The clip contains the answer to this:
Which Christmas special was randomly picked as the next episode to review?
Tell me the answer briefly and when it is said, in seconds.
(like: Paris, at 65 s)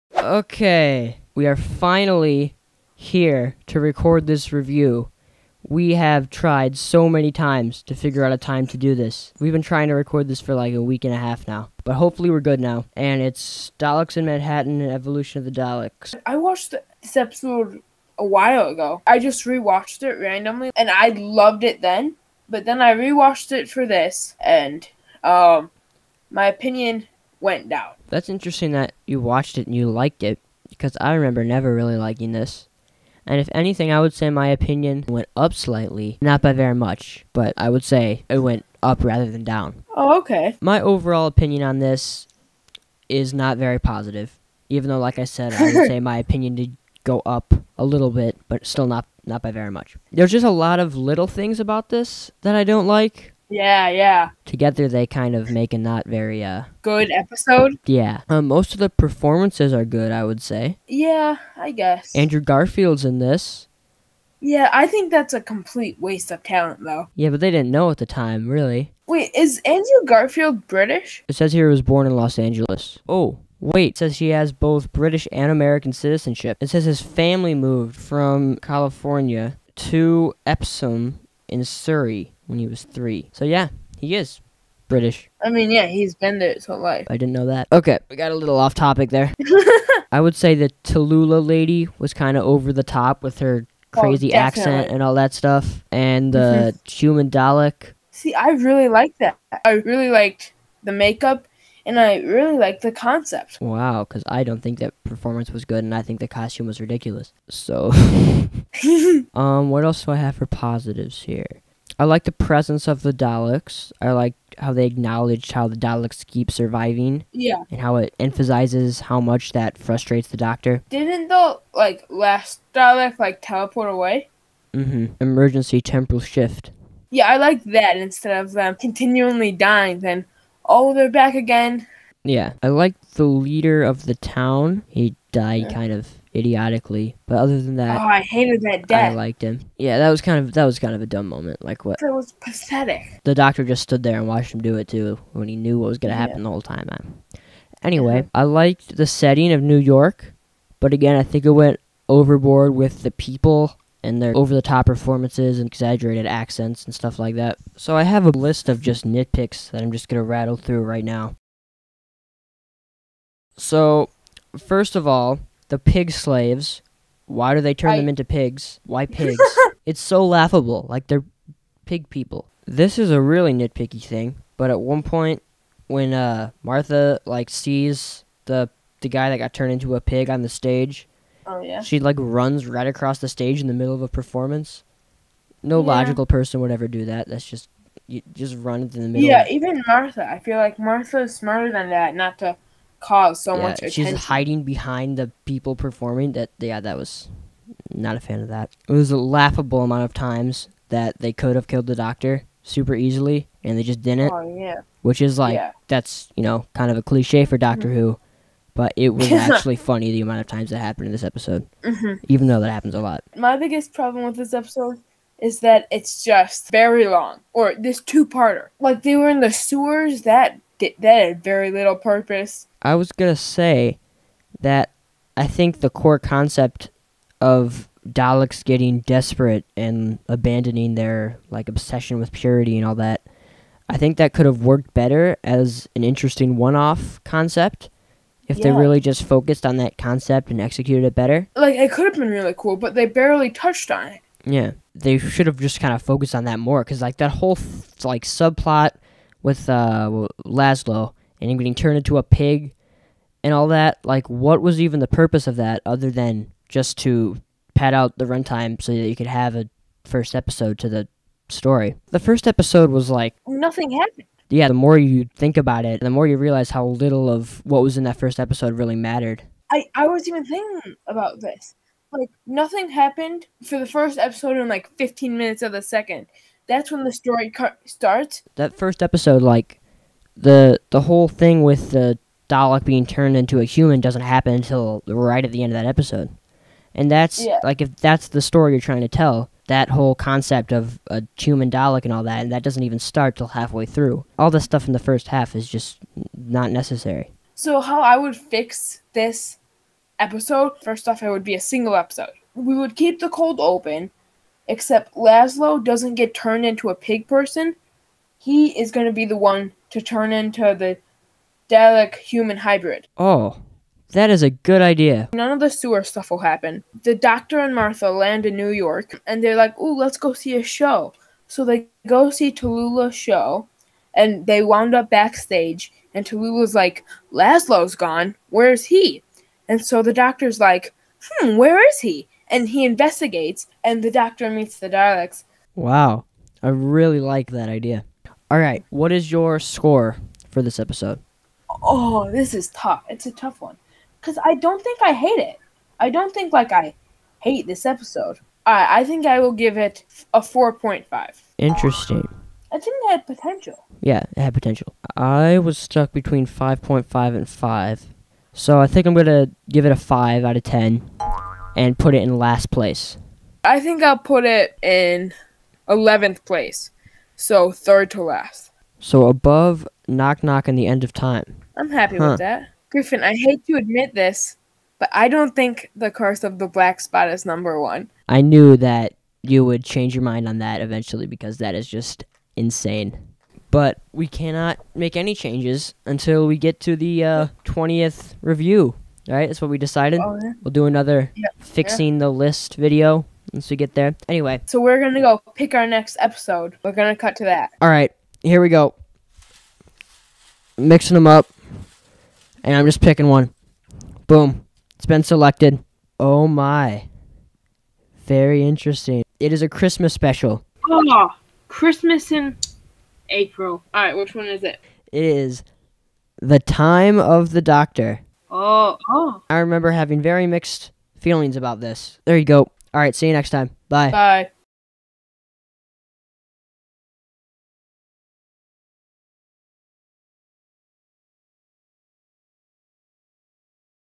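The Time of the Doctor, at 416 s.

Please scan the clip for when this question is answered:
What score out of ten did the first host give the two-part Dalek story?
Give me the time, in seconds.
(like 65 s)
350 s.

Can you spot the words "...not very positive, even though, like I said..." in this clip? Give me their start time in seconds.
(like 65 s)
43 s.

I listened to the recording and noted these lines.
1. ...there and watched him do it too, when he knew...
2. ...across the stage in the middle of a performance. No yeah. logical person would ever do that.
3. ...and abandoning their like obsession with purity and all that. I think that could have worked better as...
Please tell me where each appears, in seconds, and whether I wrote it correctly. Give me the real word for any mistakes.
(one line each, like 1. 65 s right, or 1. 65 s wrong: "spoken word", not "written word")
1. 144 s right
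2. 182 s right
3. 229 s right.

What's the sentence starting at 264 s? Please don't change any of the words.
Yeah, the more you think about it, the more you realize how little of what was in that first episode really mattered.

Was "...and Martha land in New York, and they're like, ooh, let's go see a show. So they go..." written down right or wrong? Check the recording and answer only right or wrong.
right.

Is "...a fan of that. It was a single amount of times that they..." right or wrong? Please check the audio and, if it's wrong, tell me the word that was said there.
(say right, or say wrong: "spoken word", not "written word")
wrong: "laughable", not "single".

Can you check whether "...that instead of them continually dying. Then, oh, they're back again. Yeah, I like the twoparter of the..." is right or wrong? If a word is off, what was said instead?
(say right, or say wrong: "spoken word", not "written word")
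wrong: "leader", not "twoparter".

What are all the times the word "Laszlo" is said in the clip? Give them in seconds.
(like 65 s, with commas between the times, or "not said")
250 s, 305 s, 327 s.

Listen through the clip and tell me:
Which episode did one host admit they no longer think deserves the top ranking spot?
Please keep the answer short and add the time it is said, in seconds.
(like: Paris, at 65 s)
The Curse of the Black Spot, at 375 s.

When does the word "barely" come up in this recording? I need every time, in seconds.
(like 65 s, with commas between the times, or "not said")
243 s.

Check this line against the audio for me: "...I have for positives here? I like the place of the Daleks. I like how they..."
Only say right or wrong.
wrong.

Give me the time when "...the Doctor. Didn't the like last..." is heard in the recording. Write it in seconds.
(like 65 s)
120 s.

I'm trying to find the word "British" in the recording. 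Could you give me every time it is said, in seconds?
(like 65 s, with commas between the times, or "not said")
70 s, 74 s, 84 s.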